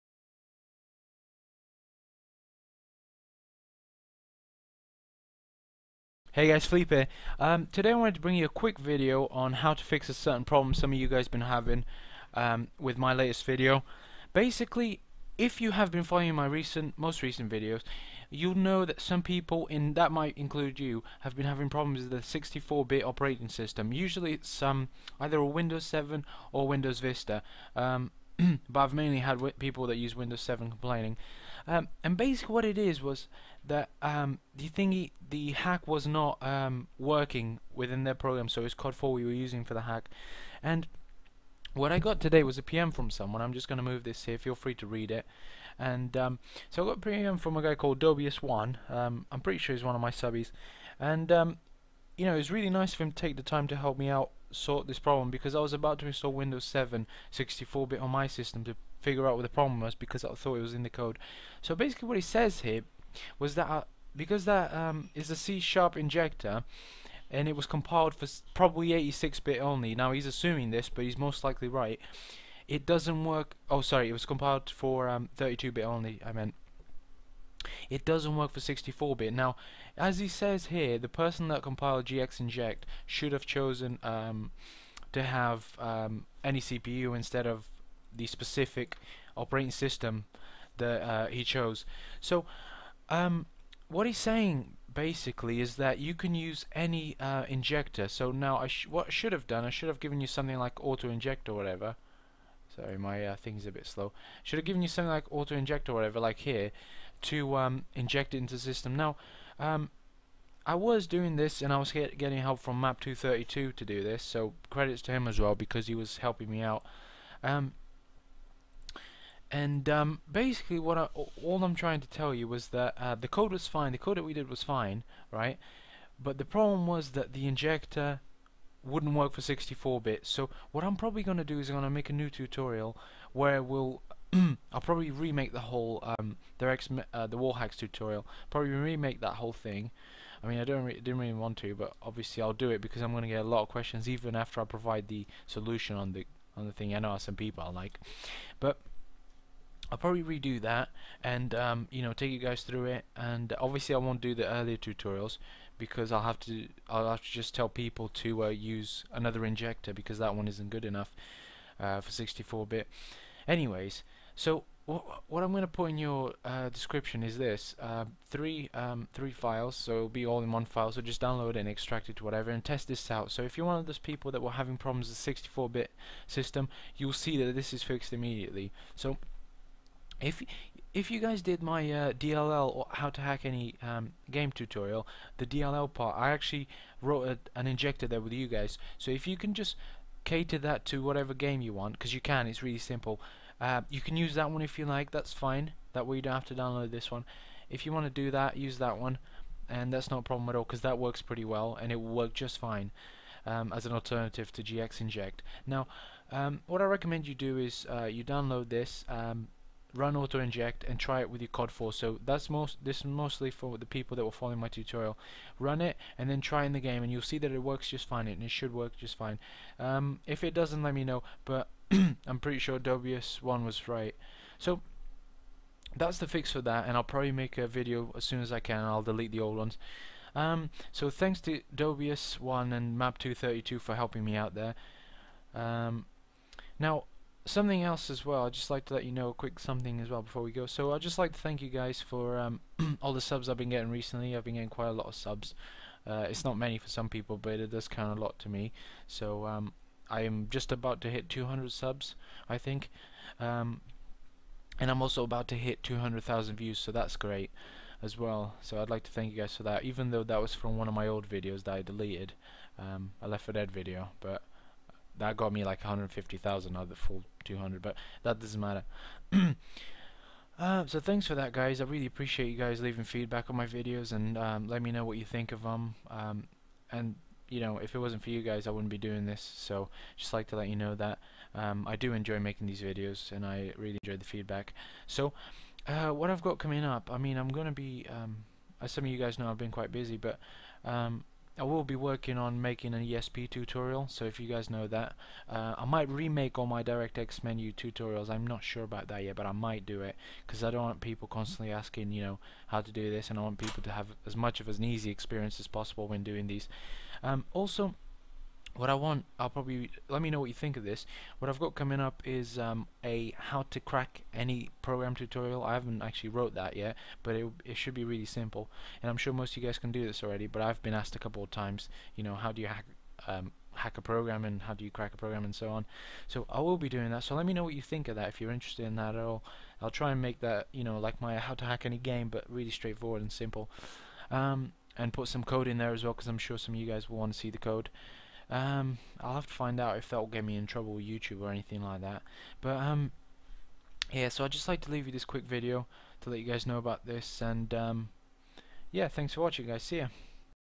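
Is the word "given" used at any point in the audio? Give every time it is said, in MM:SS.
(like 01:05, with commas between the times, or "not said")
01:39, 01:44.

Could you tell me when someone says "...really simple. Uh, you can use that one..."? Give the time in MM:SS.
03:12.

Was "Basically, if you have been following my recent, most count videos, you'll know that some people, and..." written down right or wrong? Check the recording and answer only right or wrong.
wrong.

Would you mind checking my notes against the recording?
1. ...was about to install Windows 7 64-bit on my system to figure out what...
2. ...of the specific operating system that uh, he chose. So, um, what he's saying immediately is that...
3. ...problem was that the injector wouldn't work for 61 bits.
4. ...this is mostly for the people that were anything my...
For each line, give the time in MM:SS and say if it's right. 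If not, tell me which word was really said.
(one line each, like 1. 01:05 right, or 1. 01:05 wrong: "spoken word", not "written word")
1. 00:55 right
2. 01:27 wrong: "basically", not "immediately"
3. 02:06 wrong: "64", not "61"
4. 03:32 wrong: "following", not "anything".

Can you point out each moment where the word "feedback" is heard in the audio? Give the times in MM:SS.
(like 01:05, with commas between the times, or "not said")
04:33, 04:44.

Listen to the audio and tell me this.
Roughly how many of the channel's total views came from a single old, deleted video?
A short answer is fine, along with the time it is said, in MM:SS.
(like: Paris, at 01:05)
150,000, at 04:25.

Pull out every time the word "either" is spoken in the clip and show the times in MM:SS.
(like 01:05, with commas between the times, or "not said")
00:25.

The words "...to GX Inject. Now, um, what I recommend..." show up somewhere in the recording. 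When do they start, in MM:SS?
03:24.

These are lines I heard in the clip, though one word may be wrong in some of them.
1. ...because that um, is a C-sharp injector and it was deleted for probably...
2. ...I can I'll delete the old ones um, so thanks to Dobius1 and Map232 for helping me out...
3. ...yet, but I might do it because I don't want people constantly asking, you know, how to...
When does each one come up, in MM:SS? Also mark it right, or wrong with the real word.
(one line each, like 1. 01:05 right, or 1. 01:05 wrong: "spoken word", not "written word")
1. 01:04 wrong: "compiled", not "deleted"
2. 03:48 right
3. 04:59 right.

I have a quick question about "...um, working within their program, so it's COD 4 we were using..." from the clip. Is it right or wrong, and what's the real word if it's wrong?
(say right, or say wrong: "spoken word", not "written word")
right.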